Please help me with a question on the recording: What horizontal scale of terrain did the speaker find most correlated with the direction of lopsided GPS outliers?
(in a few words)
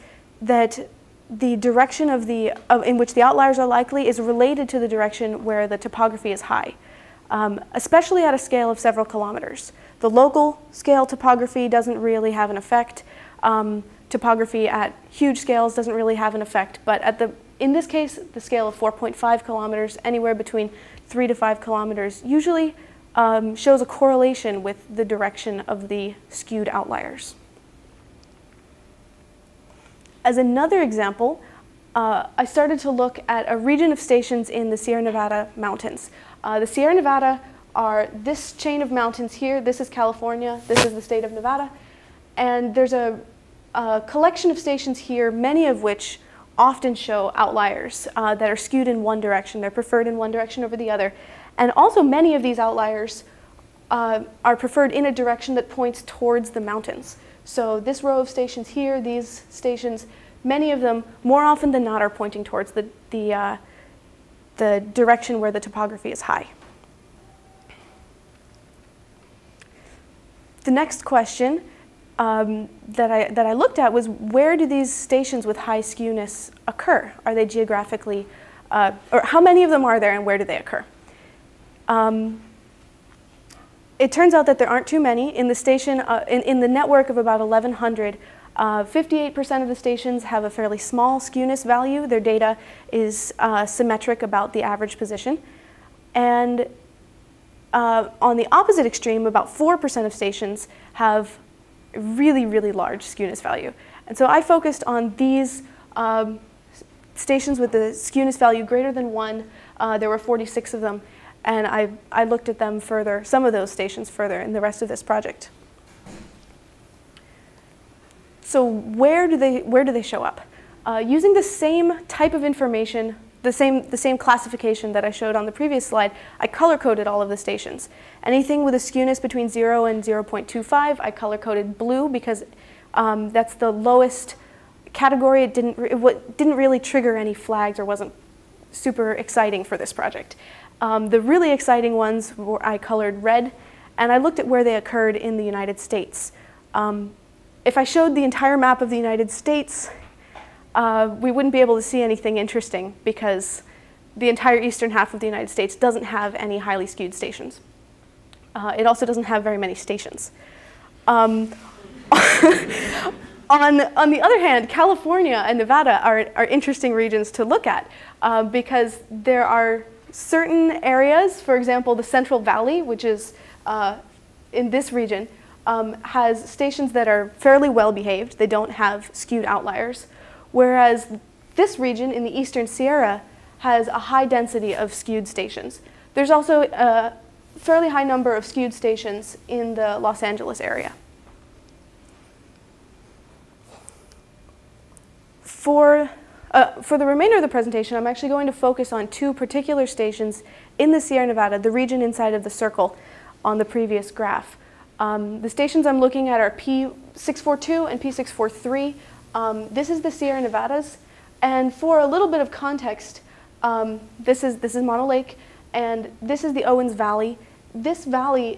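4.5 kilometers.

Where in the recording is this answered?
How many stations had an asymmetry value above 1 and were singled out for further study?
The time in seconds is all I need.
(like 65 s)
110 s.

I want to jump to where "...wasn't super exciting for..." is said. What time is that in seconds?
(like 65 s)
137 s.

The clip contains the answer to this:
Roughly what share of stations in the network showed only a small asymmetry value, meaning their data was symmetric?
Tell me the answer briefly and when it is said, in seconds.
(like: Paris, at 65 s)
58%, at 88 s.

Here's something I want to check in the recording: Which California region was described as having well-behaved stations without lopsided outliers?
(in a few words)
Central Valley.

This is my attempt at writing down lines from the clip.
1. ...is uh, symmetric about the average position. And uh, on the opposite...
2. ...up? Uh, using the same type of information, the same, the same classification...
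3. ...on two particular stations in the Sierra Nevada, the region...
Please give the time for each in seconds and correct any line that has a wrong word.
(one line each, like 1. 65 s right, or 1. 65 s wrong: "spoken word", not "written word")
1. 92 s right
2. 120 s right
3. 198 s right.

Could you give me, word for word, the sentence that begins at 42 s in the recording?
And there's a, a collection of stations here, many of which often show outliers uh, that are skewed in one direction.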